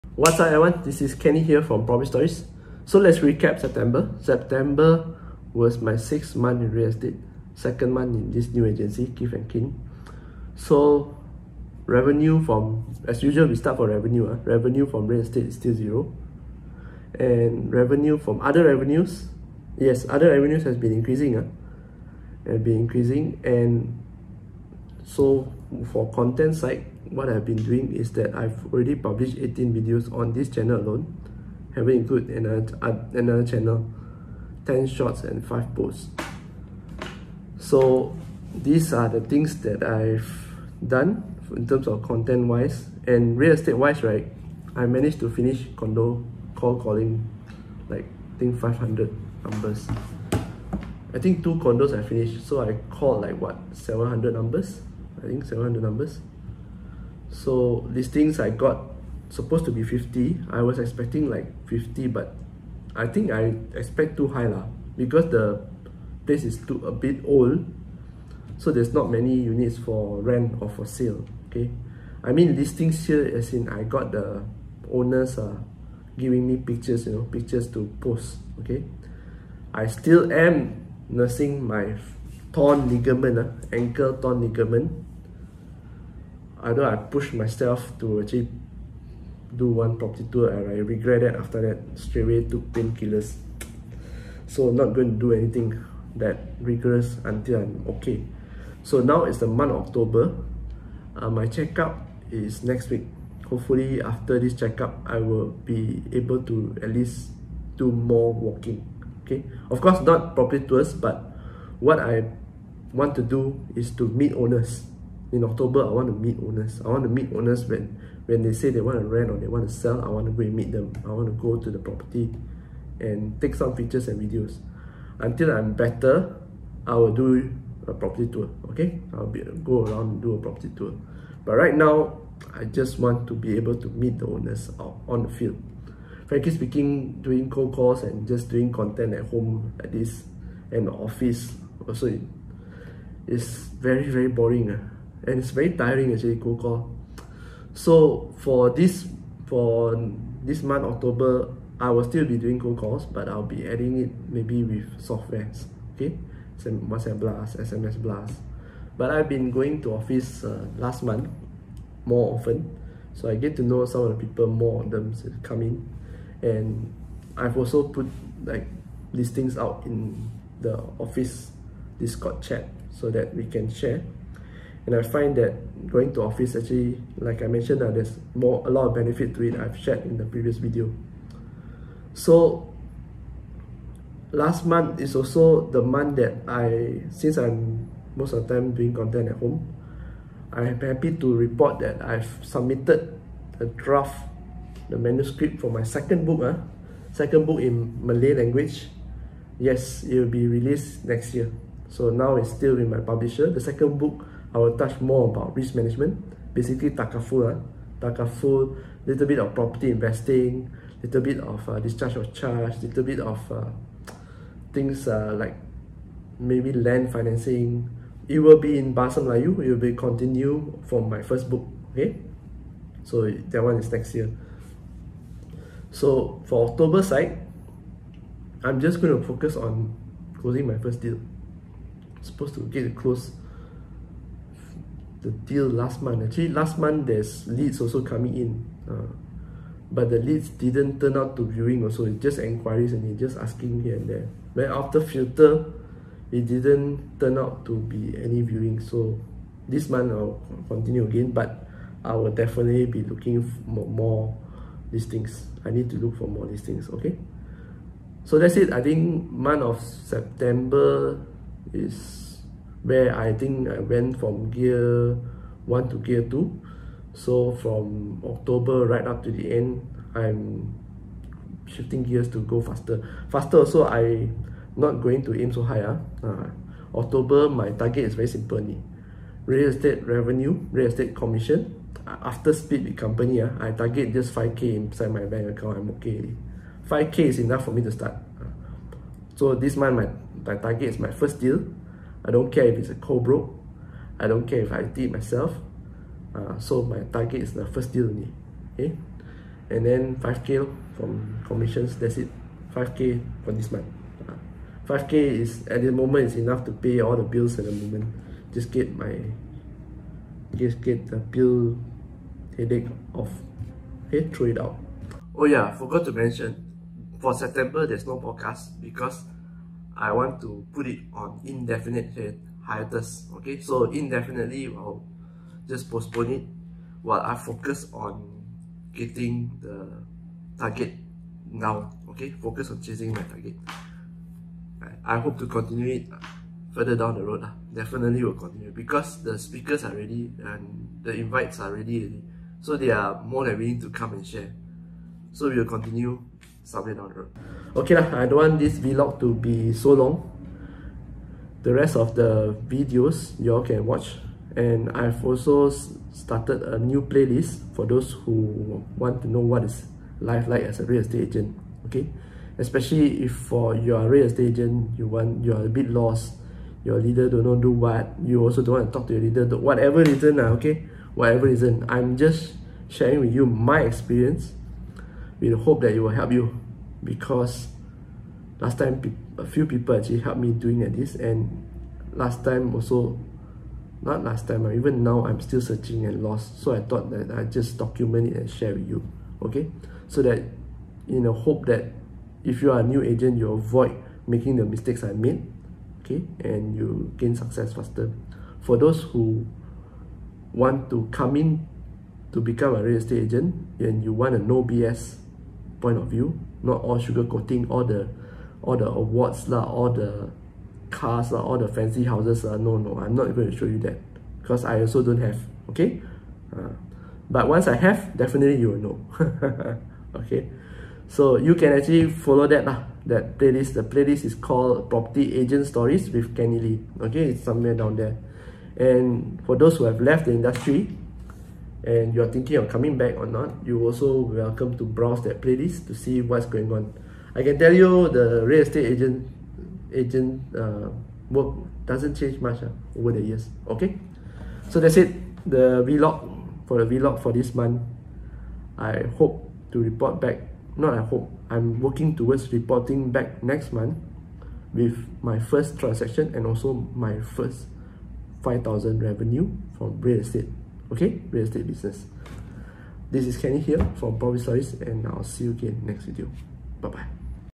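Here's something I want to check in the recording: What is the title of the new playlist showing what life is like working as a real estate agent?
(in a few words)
Property Agent Stories with Kenny Lee.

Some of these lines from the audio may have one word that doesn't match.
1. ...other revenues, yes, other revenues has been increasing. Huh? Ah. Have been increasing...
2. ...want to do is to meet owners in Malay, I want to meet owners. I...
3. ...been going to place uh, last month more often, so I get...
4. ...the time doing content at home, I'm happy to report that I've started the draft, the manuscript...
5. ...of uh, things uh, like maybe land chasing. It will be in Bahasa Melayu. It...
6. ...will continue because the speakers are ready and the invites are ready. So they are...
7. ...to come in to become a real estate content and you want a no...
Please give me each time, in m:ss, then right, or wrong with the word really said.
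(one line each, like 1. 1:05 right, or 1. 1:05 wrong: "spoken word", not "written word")
1. 0:18 right
2. 1:52 wrong: "October", not "Malay"
3. 2:39 wrong: "office", not "place"
4. 3:08 wrong: "submitted", not "started"
5. 3:33 wrong: "financing", not "chasing"
6. 5:38 right
7. 6:40 wrong: "agent", not "content".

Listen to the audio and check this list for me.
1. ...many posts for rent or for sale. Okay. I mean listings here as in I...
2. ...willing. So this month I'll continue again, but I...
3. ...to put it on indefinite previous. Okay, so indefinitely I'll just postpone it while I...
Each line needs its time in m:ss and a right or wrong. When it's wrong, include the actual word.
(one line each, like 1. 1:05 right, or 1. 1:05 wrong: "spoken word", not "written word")
1. 1:09 wrong: "units", not "posts"
2. 4:08 wrong: "viewing", not "willing"
3. 5:20 wrong: "hiatus", not "previous".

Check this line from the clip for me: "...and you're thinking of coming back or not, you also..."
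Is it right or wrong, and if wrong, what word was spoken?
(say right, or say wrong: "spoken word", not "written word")
right.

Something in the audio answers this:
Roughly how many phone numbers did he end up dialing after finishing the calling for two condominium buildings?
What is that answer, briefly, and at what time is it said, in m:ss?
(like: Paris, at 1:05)
700, at 0:55.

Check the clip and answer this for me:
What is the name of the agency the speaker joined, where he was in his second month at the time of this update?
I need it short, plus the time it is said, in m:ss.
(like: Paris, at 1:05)
Keith and King, at 0:09.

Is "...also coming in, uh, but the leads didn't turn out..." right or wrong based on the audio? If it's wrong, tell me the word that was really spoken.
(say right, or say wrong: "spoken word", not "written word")
right.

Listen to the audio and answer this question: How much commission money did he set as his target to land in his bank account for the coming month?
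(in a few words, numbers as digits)
5k.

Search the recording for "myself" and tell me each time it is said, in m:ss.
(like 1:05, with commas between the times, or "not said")
1:27, 4:55.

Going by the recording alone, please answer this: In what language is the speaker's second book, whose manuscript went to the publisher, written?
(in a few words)
Malay.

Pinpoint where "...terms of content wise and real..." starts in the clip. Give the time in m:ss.
0:41.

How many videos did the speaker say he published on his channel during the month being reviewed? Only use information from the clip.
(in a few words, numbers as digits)
18.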